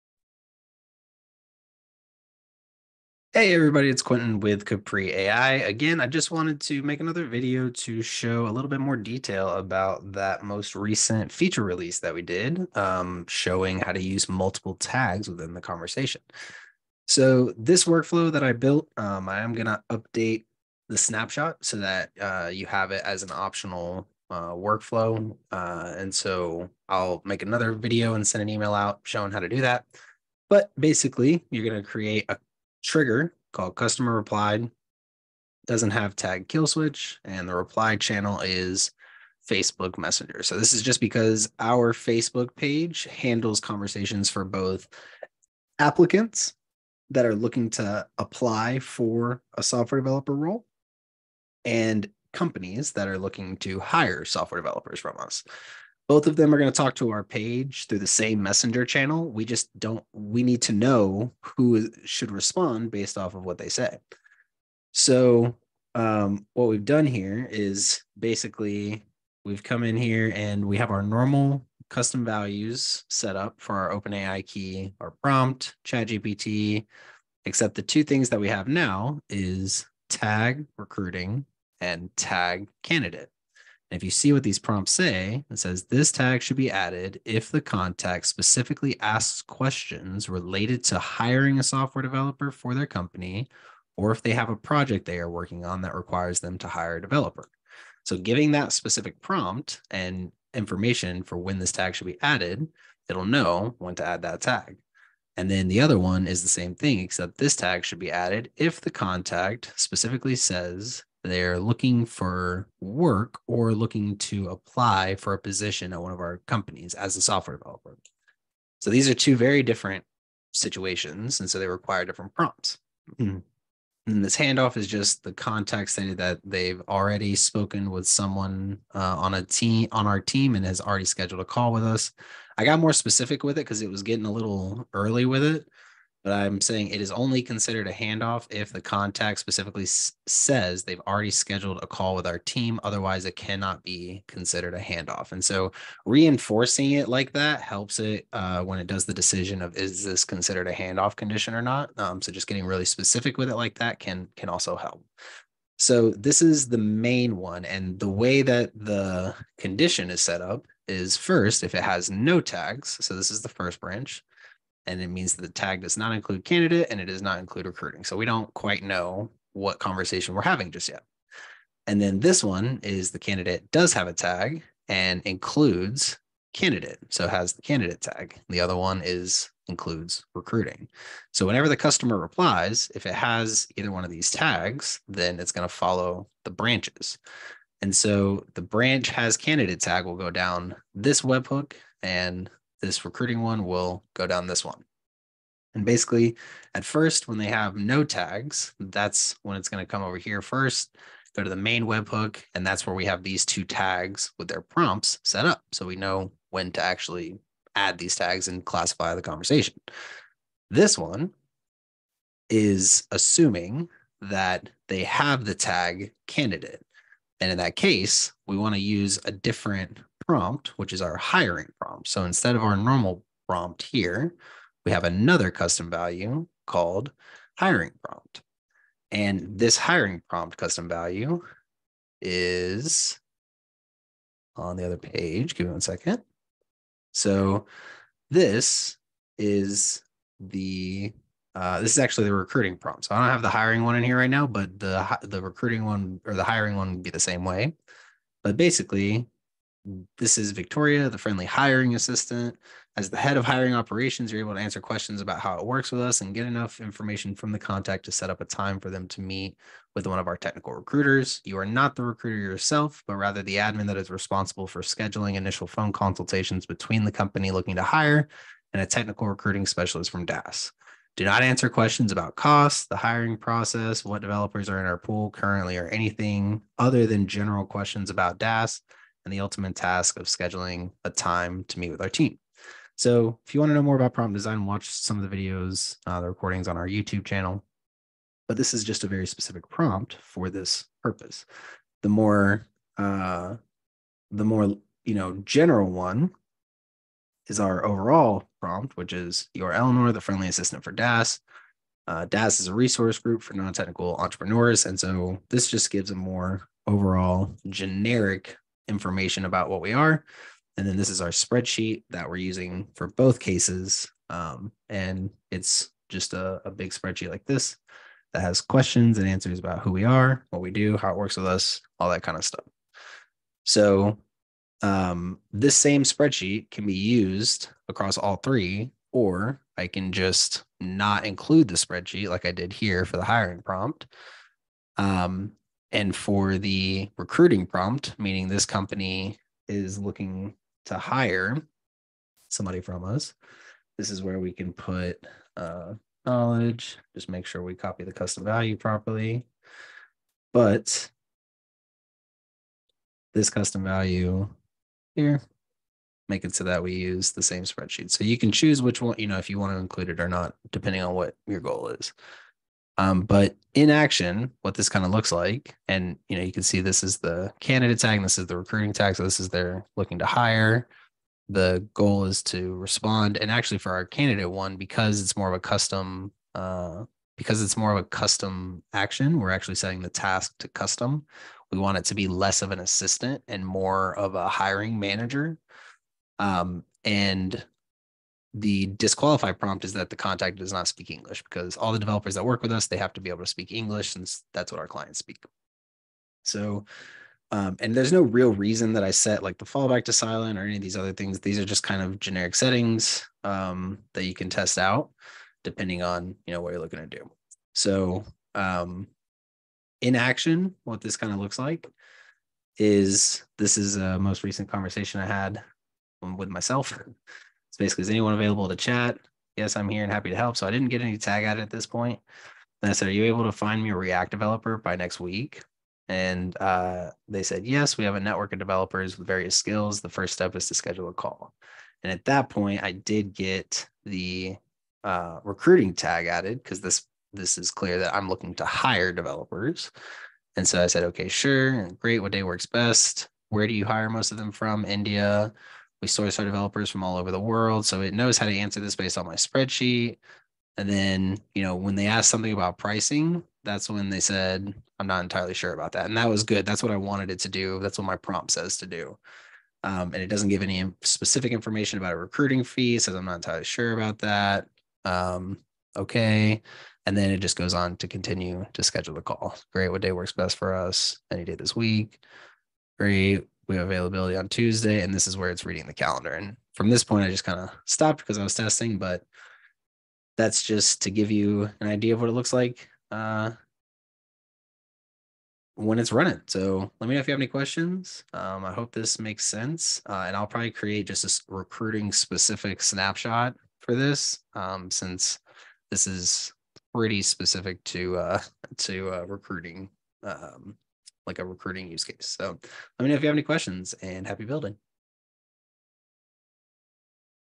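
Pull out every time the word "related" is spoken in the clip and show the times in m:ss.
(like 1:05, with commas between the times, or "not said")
1:30.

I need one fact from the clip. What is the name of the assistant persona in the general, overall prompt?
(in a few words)
Eleanor.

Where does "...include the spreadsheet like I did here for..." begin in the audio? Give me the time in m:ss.
5:31.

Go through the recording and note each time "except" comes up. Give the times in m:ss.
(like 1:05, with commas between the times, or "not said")
1:17, 1:46.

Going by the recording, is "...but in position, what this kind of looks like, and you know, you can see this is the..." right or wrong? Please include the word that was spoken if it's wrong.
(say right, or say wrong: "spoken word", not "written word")
wrong: "action", not "position".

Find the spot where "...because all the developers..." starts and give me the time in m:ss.
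6:31.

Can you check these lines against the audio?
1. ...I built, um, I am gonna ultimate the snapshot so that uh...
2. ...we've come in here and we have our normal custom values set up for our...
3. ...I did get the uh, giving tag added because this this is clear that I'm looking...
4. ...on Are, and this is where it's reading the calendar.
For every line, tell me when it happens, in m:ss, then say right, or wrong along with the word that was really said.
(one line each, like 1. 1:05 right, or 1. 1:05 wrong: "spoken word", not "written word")
1. 0:18 wrong: "update", not "ultimate"
2. 1:09 right
3. 7:12 wrong: "recruiting", not "giving"
4. 7:54 wrong: "Tuesday", not "Are".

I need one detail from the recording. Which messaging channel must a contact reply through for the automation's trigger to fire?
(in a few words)
Facebook Messenger.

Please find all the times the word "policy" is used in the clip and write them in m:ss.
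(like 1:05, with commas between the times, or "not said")
not said.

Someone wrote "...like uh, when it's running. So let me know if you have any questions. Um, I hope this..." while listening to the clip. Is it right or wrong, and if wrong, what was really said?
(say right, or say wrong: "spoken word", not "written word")
right.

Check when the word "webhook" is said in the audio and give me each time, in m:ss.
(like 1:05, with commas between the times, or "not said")
3:11, 3:21.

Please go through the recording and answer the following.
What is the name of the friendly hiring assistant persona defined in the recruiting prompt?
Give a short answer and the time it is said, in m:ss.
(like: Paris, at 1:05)
Victoria, at 4:10.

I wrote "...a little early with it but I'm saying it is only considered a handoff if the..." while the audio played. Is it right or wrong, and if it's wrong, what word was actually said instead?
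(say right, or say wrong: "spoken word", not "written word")
right.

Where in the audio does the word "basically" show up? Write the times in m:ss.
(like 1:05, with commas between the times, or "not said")
0:30, 1:08, 3:15, 4:08, 6:57.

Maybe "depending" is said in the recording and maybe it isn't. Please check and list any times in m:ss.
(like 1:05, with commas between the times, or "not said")
6:00, 6:45.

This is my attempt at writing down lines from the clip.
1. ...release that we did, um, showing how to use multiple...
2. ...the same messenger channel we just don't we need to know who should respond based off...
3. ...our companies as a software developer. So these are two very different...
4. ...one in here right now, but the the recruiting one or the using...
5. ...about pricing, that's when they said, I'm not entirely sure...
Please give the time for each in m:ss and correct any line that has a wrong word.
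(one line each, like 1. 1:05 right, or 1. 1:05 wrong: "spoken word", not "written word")
1. 0:11 right
2. 0:57 right
3. 1:56 right
4. 4:03 wrong: "hiring", not "using"
5. 7:32 right.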